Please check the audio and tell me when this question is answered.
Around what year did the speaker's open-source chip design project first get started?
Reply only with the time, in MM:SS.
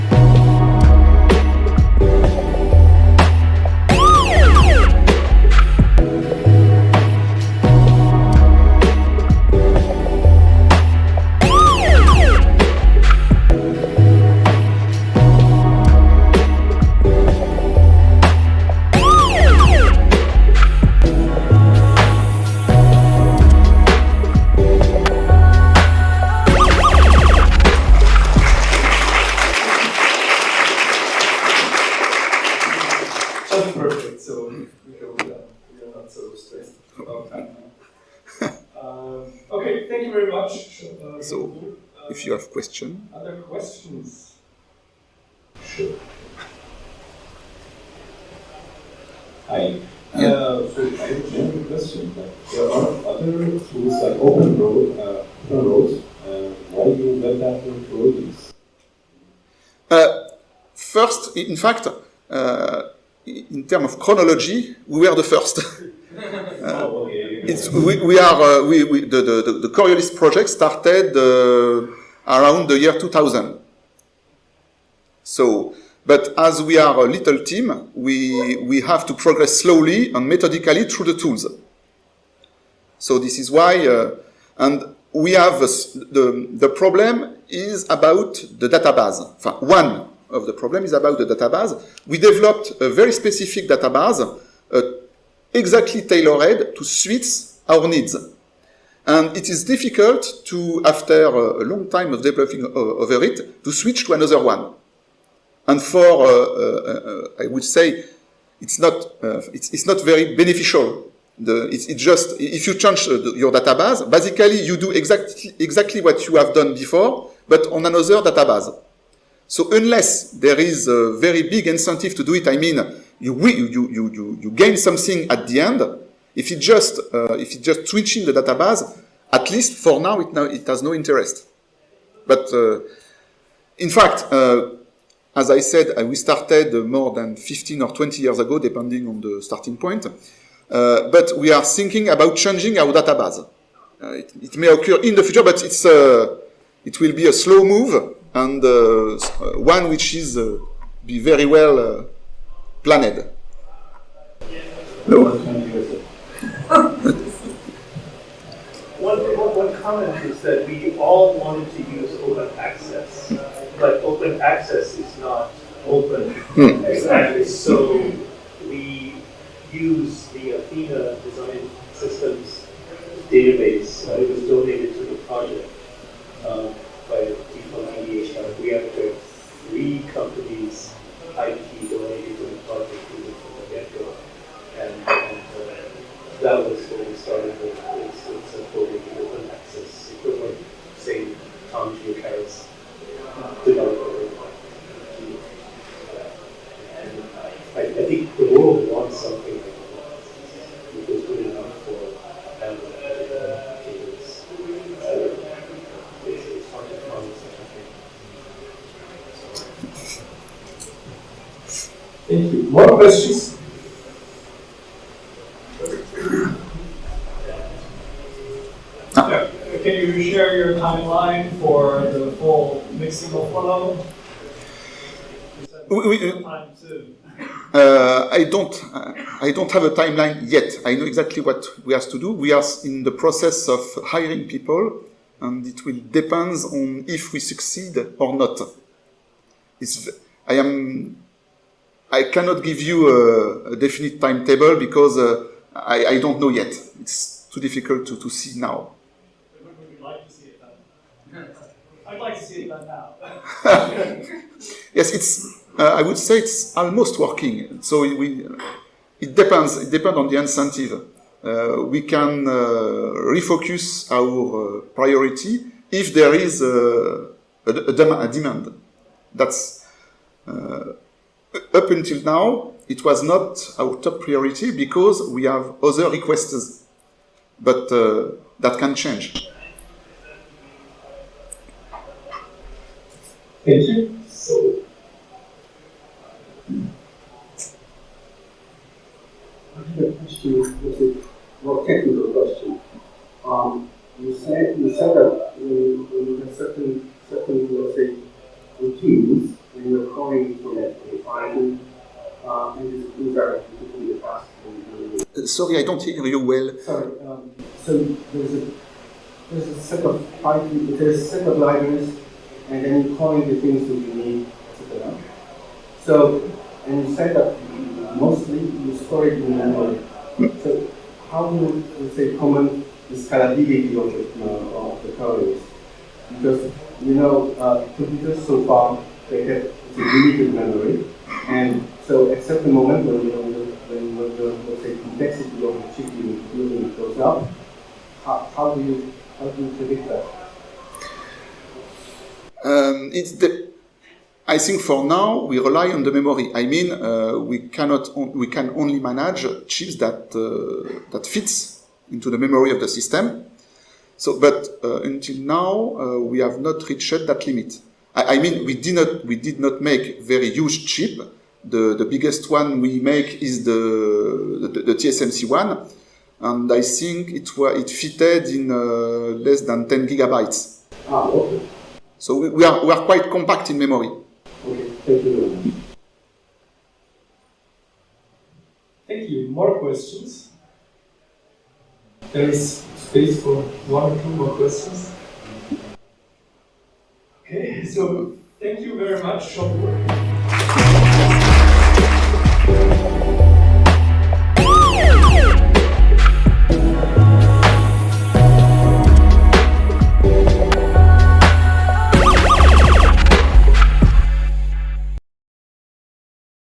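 01:12.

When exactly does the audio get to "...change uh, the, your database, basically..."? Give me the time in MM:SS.
01:52.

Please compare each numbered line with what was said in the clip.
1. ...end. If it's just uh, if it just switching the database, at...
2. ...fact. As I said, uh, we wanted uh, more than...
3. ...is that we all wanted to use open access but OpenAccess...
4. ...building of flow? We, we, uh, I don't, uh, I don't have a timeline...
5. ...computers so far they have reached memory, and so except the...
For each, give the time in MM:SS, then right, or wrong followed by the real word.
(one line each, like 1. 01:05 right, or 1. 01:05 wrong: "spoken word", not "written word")
1. 02:05 right
2. 02:13 wrong: "started", not "wanted"
3. 02:40 right
4. 03:42 wrong: "mixing", not "building"
5. 05:27 wrong: "limited", not "reached".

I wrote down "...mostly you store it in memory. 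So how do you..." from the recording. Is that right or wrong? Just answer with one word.
right.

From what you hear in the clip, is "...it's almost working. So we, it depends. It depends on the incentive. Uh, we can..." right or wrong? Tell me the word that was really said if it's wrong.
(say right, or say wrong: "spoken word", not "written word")
right.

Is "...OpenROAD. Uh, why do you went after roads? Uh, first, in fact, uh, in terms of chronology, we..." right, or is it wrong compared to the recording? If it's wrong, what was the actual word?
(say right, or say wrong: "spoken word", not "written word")
right.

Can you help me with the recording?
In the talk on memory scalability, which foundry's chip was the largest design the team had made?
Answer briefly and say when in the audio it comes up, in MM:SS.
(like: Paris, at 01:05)
TSMC, at 06:04.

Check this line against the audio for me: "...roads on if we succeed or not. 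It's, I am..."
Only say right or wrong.
wrong.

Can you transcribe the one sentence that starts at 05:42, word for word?
Um, it's the I think for now we rely on the memory.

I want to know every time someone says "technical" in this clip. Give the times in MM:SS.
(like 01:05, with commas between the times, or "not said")
04:51.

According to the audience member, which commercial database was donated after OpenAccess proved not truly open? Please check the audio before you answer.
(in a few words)
Athena Design Systems.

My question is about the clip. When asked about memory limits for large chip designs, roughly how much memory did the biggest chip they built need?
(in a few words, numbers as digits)
less than 10 gigabytes.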